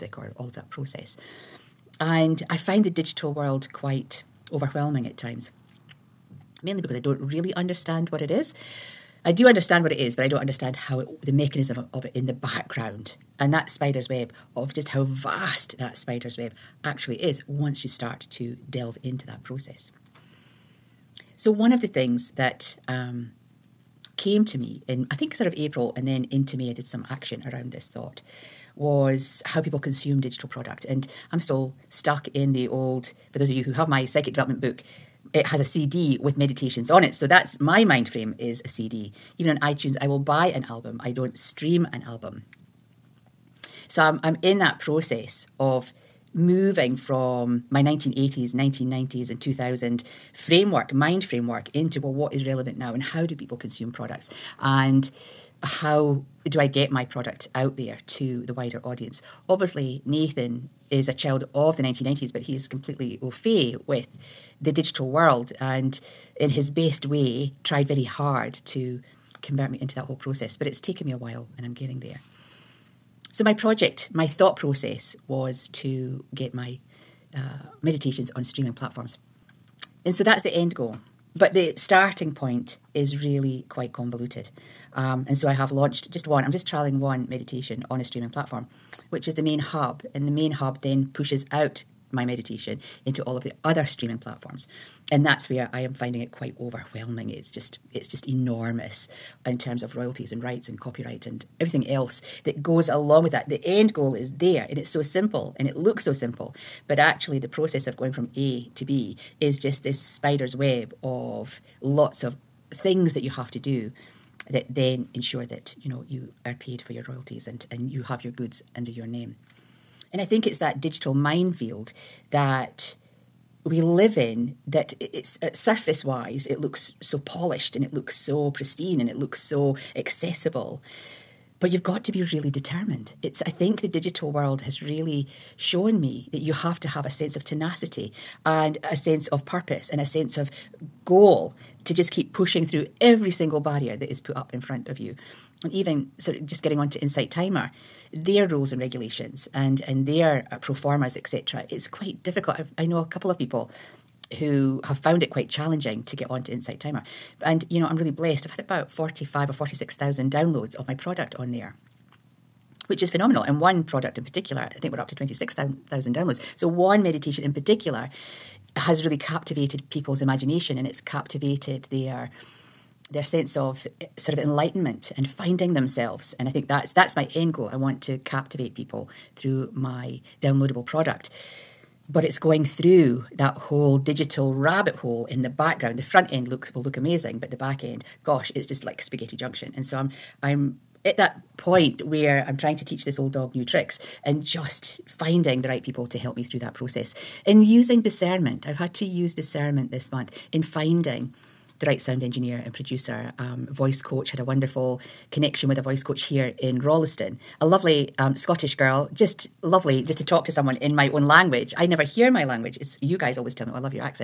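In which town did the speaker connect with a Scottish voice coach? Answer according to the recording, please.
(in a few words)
Rolleston.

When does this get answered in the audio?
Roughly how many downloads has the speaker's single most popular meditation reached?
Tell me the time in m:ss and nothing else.
2:45.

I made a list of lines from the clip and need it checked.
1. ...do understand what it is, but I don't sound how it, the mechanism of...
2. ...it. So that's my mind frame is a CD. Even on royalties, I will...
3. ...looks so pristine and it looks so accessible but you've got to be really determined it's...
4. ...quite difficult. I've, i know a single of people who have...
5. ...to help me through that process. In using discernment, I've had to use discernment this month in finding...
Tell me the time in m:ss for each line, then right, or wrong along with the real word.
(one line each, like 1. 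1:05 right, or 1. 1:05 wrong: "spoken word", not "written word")
1. 0:09 wrong: "understand", not "sound"
2. 0:37 wrong: "iTunes", not "royalties"
3. 2:07 right
4. 2:31 wrong: "couple", not "single"
5. 3:16 right.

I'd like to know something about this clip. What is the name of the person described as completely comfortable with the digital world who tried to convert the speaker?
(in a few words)
Nathan.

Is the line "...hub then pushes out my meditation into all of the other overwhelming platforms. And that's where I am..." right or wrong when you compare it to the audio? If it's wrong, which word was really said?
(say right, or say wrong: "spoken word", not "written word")
wrong: "streaming", not "overwhelming".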